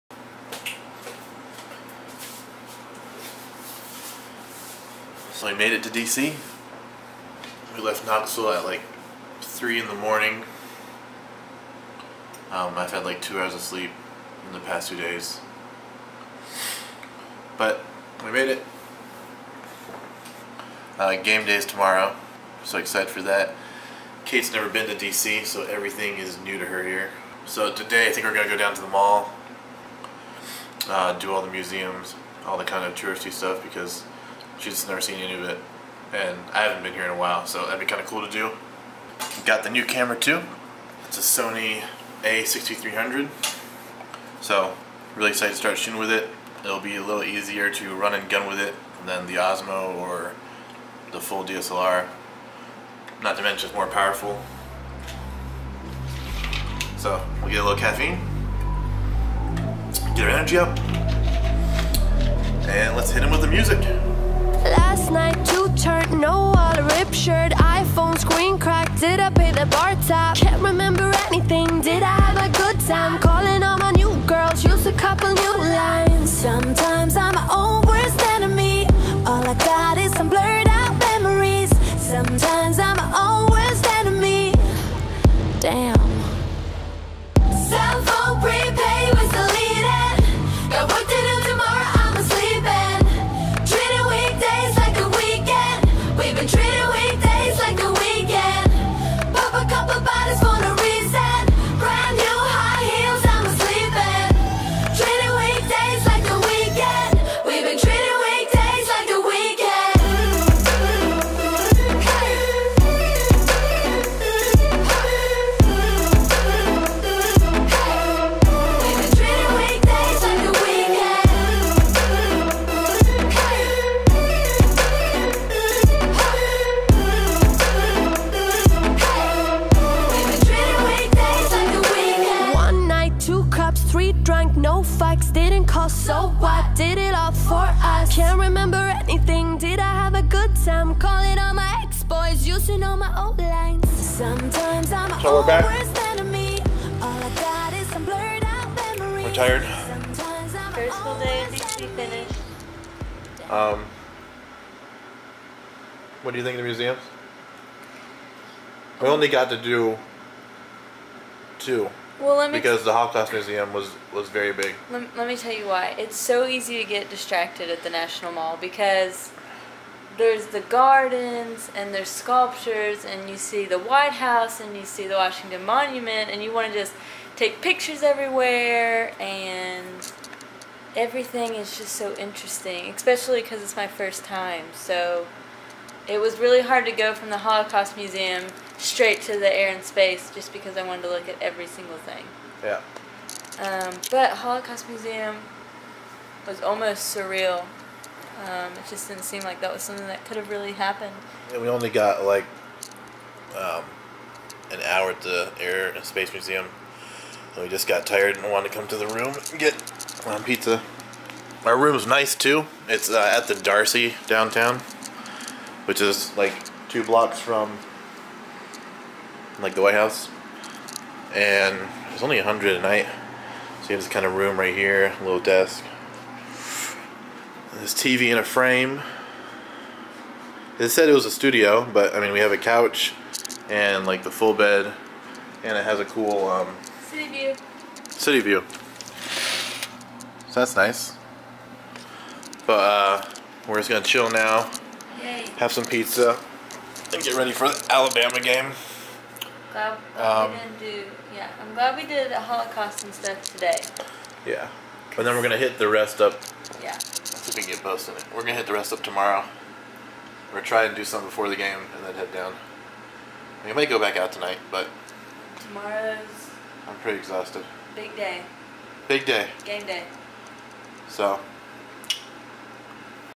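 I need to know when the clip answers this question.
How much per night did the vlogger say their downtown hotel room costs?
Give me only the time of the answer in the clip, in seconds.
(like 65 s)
222 s.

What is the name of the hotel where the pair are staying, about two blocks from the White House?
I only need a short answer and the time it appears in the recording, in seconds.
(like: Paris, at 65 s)
The Darcy, at 213 s.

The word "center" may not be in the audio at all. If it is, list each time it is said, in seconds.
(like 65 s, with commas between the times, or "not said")
not said.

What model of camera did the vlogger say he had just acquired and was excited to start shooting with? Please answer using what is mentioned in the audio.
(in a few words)
Sony A6300.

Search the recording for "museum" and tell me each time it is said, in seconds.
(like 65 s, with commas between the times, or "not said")
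31 s, 156 s, 163 s, 187 s, 194 s, 206 s.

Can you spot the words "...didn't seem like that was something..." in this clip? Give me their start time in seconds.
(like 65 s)
199 s.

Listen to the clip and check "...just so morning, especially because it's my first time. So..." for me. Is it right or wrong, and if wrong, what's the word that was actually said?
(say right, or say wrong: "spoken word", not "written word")
wrong: "interesting", not "morning".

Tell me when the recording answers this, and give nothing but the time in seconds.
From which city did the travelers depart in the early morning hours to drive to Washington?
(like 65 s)
8 s.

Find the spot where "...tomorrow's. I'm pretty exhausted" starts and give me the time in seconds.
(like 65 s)
265 s.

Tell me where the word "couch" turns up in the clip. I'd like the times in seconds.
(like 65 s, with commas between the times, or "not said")
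232 s.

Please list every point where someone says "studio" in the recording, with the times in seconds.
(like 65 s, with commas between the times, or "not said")
231 s.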